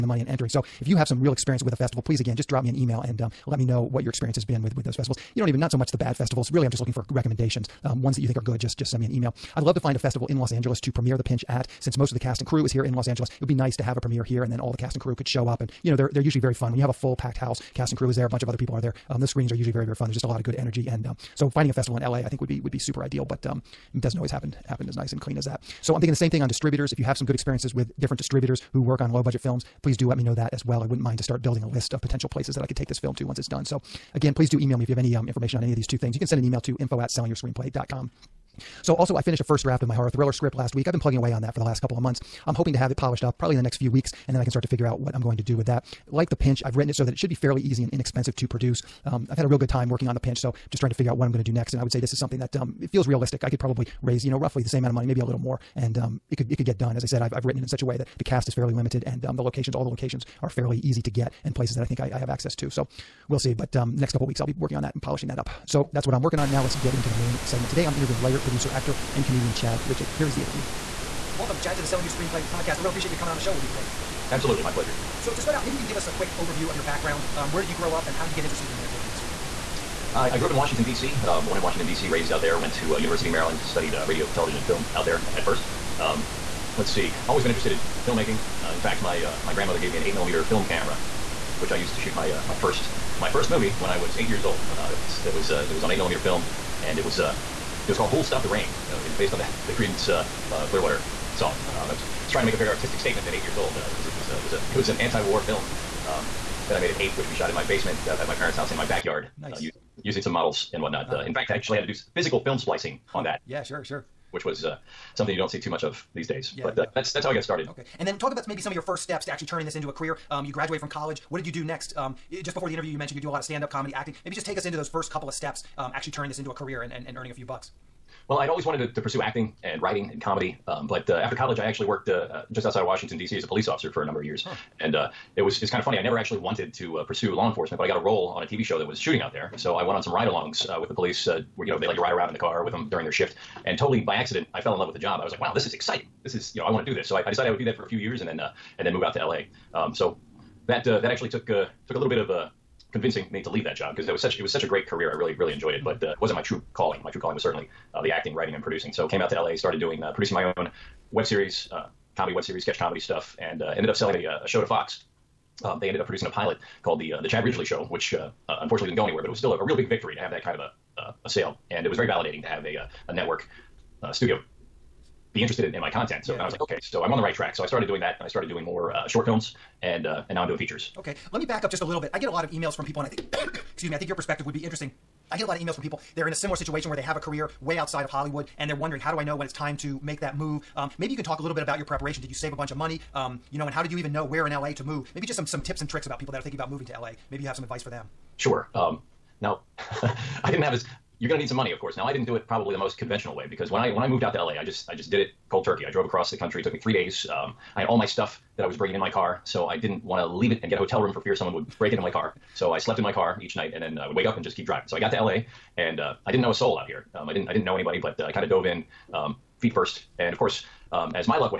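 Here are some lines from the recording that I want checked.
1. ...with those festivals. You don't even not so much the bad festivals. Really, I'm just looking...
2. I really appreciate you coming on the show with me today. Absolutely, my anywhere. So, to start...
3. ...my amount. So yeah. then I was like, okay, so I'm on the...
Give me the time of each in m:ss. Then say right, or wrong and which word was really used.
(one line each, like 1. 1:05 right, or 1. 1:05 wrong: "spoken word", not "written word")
1. 0:04 right
2. 1:12 wrong: "pleasure", not "anywhere"
3. 2:55 wrong: "content", not "amount".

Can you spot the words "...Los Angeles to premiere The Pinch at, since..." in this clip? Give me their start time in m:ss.
0:10.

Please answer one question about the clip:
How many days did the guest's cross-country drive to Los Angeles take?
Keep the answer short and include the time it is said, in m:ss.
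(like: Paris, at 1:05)
3, at 3:26.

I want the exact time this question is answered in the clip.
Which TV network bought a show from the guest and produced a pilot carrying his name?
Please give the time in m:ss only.
2:44.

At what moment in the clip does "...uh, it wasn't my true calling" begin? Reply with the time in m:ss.
2:36.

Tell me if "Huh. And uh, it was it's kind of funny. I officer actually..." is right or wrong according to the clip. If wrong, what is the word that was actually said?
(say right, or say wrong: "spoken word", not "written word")
wrong: "never", not "officer".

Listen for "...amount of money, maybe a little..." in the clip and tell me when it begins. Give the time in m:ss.
0:54.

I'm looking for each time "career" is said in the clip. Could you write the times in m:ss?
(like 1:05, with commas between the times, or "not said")
1:59, 2:06, 2:34, 3:07.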